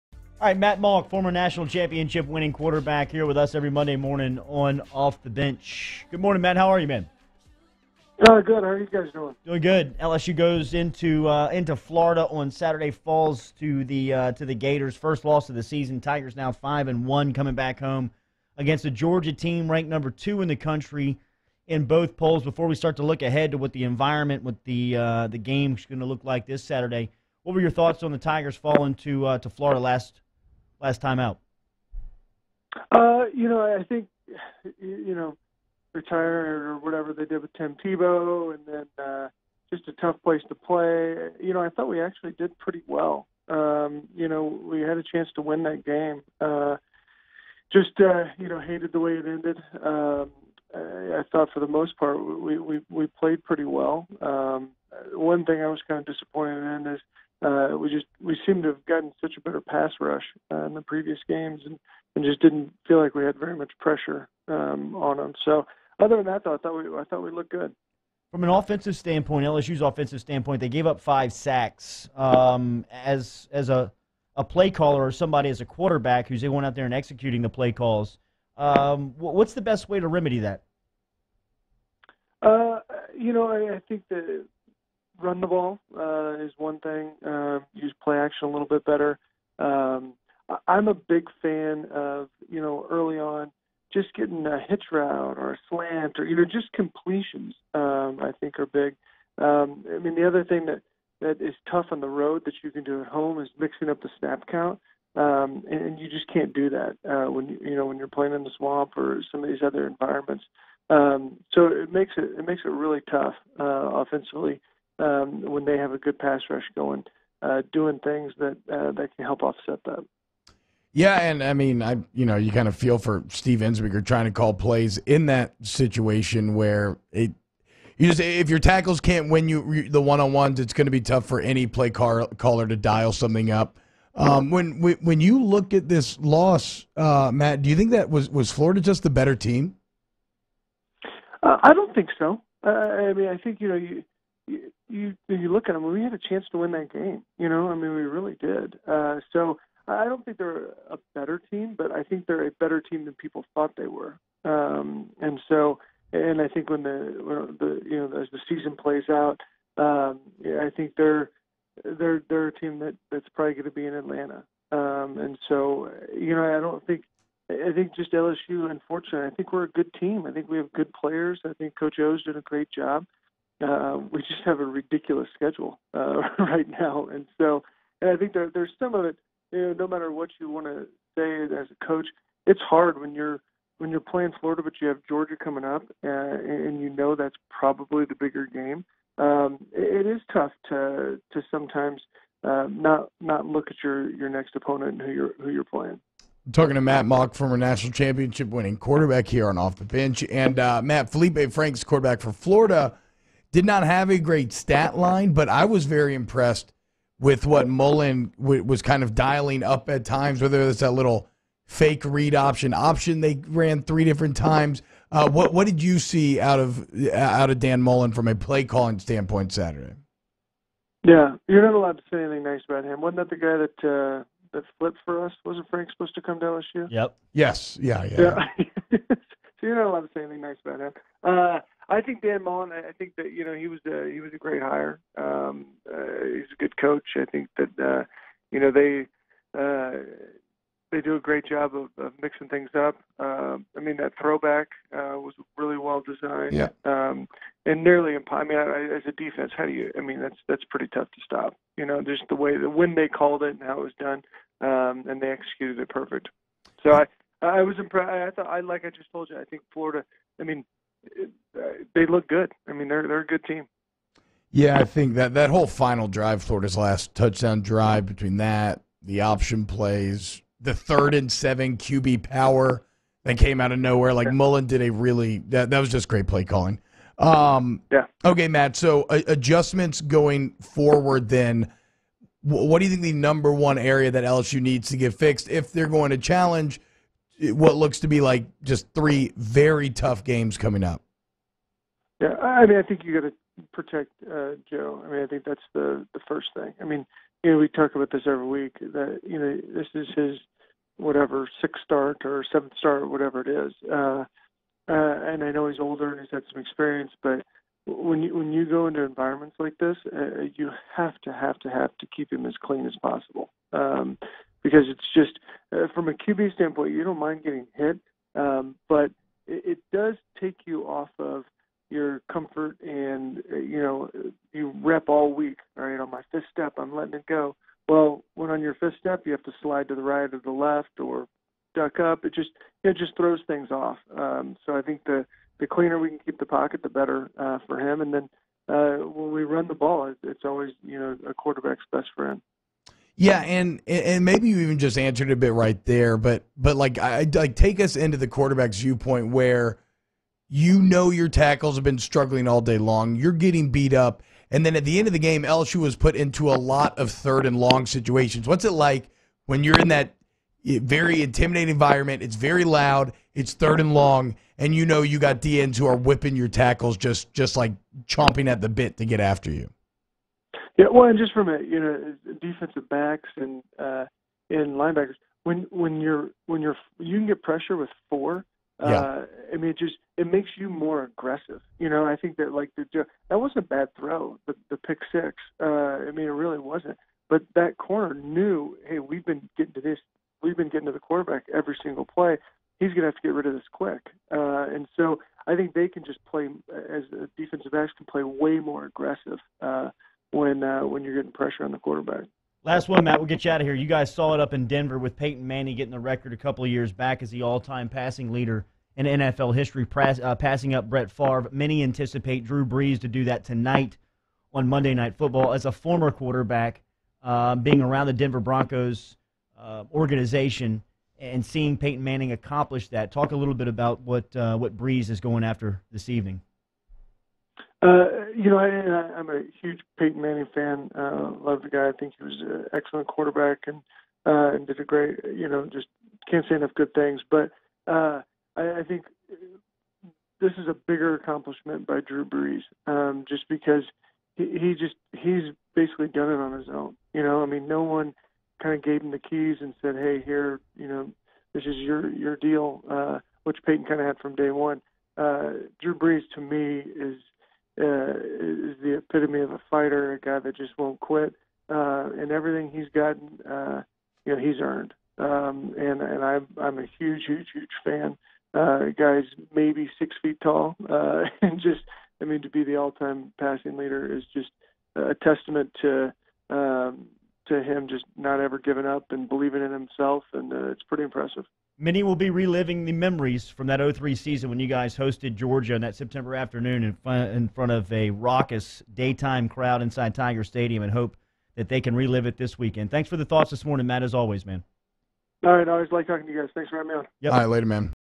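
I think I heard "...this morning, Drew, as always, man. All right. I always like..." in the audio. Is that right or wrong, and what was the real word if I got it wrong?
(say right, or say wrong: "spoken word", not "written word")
wrong: "Matt", not "Drew".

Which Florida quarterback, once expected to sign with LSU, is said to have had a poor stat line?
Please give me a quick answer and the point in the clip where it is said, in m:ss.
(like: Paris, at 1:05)
Felipe Franks, at 3:21.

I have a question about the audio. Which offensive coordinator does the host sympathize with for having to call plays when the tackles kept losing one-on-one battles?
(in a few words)
Steve Ensminger.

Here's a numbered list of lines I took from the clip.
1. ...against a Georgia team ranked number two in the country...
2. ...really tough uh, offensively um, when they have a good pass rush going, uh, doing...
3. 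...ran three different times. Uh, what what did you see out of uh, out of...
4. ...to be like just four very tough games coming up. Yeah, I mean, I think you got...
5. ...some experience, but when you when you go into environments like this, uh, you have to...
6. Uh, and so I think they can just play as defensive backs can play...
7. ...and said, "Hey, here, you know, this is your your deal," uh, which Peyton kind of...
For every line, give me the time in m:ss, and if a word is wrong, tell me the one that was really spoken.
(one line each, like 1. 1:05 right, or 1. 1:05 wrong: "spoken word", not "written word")
1. 0:18 right
2. 1:52 right
3. 3:33 right
4. 4:48 wrong: "three", not "four"
5. 5:06 right
6. 6:34 right
7. 7:29 right.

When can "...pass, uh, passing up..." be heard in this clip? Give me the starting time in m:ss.
6:49.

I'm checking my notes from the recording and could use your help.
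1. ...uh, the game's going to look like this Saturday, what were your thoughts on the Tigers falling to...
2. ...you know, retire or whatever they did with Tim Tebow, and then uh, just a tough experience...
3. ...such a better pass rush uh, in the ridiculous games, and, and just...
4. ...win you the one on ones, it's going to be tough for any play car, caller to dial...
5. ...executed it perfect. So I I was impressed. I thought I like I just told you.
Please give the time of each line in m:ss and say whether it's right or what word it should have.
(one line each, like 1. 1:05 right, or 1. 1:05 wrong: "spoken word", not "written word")
1. 0:24 right
2. 0:34 wrong: "place", not "experience"
3. 0:59 wrong: "previous", not "ridiculous"
4. 2:09 right
5. 4:15 right.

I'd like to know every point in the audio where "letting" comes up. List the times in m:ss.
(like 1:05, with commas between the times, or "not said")
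5:26.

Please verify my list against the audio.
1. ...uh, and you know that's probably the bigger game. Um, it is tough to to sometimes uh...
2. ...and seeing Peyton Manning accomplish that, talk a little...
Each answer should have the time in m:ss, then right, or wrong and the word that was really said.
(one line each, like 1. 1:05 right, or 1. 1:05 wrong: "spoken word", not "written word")
1. 3:06 right
2. 7:01 right.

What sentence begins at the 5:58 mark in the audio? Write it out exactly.
What's it like when you're in that very intimidating environment?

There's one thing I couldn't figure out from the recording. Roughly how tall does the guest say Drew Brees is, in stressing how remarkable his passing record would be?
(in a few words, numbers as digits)
6 feet.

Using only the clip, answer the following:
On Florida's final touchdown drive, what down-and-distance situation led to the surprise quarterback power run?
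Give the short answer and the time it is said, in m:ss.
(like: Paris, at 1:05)
third and seven, at 4:30.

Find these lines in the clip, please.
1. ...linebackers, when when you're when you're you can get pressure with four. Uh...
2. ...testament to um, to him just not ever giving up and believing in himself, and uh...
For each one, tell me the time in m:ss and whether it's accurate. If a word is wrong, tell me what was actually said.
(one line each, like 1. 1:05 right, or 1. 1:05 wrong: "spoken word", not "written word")
1. 6:14 right
2. 7:55 right.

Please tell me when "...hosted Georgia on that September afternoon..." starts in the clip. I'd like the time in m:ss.
8:04.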